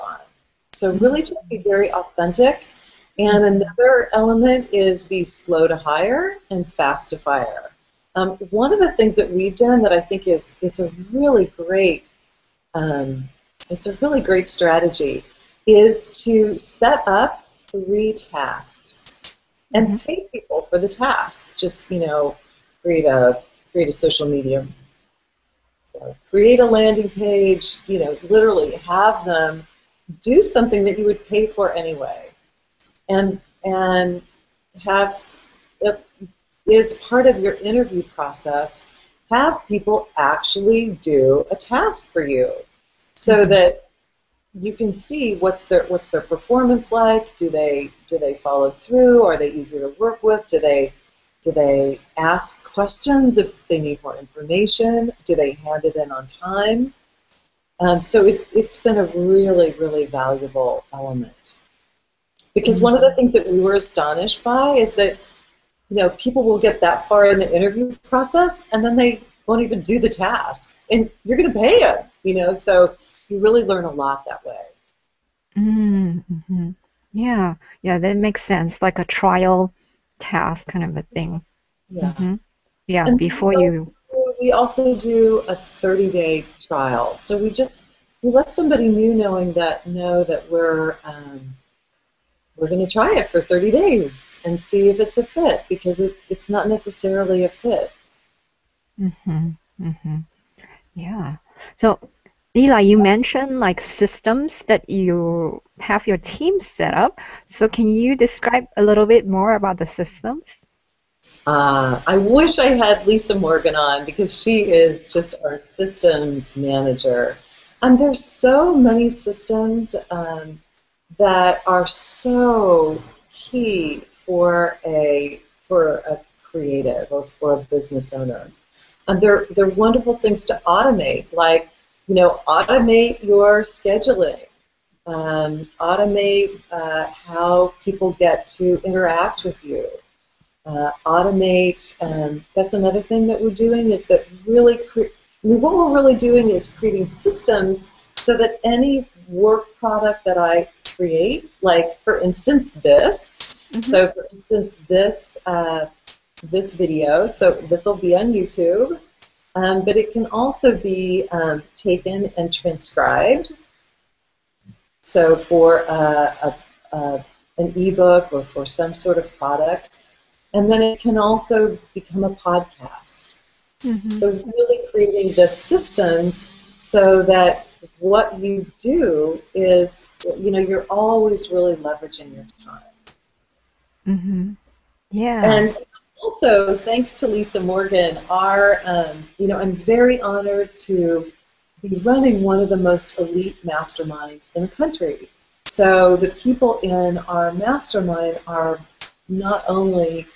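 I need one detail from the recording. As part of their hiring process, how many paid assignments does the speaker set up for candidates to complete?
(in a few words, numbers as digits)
3.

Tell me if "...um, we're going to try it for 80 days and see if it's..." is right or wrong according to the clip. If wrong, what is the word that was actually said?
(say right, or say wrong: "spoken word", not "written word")
wrong: "30", not "80".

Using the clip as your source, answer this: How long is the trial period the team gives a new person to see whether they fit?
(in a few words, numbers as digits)
30 days.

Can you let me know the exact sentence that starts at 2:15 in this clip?
Um, automate uh, how people get to interact with you.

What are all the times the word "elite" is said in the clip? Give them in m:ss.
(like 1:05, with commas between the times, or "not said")
3:13.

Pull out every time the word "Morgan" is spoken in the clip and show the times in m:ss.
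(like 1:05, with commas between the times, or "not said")
1:53, 3:07.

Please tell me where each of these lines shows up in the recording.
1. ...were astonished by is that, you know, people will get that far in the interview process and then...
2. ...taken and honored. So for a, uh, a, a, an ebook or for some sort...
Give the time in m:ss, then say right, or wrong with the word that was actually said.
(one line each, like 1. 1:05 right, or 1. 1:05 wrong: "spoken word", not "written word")
1. 1:03 right
2. 2:41 wrong: "transcribed", not "honored".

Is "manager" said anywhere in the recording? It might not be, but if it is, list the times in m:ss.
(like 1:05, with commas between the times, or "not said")
1:56.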